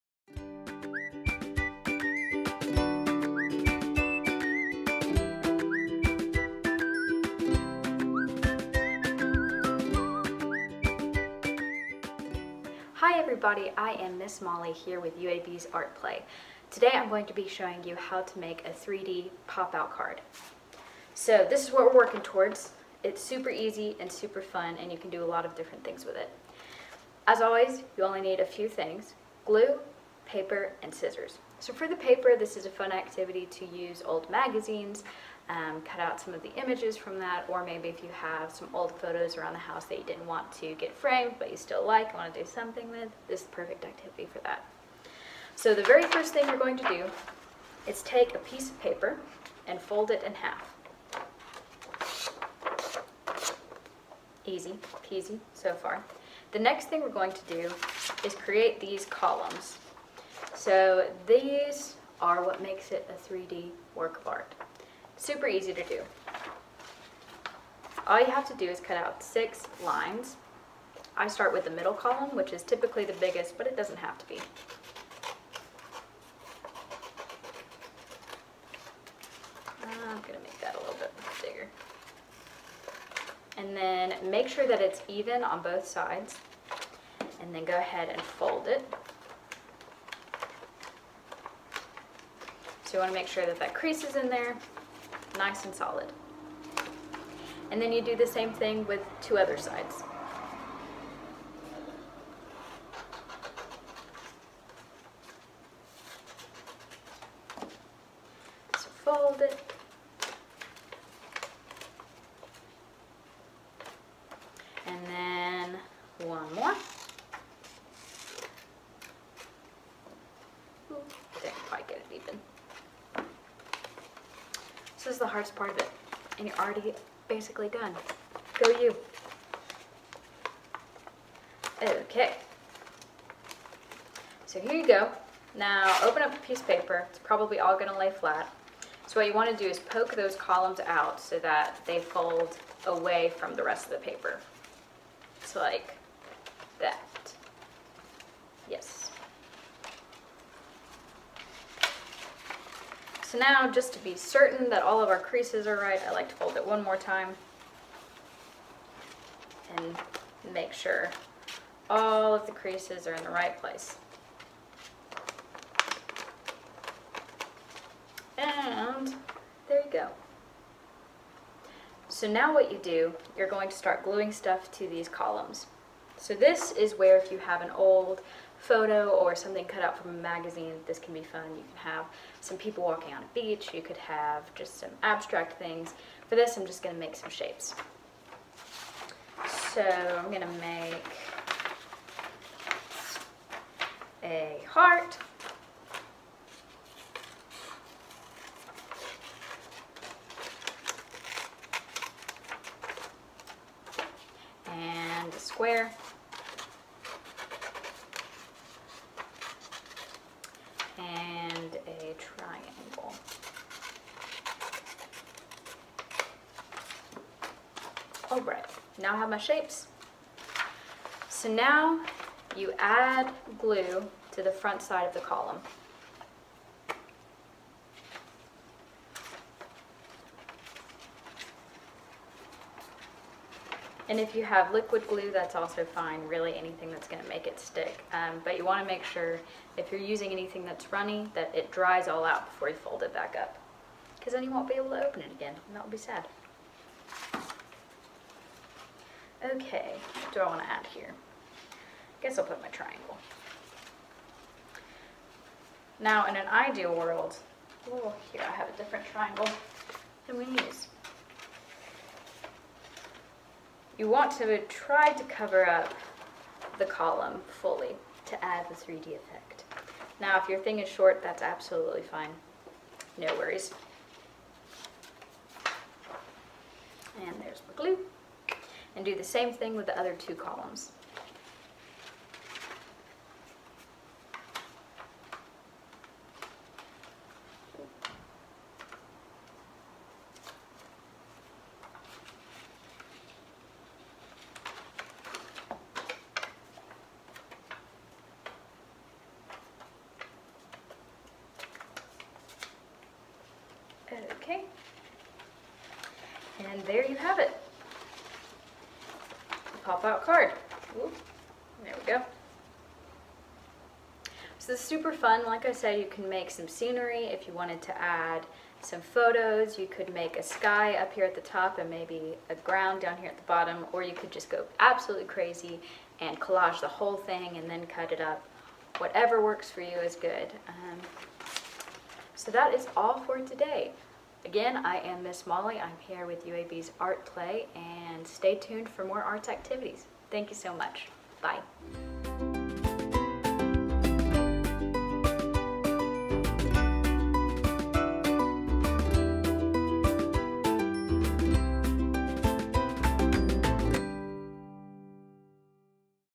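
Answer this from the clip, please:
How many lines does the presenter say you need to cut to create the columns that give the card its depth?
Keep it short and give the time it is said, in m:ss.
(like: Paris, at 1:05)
6, at 1:09.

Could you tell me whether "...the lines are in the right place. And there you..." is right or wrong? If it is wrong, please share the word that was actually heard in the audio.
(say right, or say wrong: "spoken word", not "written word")
wrong: "creases", not "lines".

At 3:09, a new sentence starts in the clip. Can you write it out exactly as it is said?
So I'm going to make a heart.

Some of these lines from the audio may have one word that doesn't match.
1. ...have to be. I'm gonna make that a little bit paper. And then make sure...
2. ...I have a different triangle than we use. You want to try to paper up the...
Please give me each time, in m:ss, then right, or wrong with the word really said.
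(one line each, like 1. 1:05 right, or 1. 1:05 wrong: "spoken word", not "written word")
1. 1:13 wrong: "bigger", not "paper"
2. 4:18 wrong: "cover", not "paper".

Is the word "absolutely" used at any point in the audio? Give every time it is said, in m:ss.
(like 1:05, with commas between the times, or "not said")
4:31, 5:24.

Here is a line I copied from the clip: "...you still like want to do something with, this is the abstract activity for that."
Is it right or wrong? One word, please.
wrong.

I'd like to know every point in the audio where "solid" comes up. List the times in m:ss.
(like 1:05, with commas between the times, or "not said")
1:35.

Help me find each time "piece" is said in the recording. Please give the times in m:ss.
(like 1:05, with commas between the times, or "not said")
0:48, 2:16.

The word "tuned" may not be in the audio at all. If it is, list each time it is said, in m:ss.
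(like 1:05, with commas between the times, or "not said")
5:38.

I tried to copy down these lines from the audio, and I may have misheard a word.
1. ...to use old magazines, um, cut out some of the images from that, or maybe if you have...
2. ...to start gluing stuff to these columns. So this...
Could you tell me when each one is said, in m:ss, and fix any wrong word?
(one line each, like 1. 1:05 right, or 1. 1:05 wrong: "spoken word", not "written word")
1. 0:33 right
2. 2:53 right.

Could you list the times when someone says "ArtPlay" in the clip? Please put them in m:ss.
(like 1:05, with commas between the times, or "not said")
0:15, 5:36.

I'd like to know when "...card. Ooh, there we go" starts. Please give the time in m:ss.
5:10.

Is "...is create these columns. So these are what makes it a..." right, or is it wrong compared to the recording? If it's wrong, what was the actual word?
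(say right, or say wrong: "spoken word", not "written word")
right.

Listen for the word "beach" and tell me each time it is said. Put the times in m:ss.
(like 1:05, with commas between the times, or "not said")
3:03.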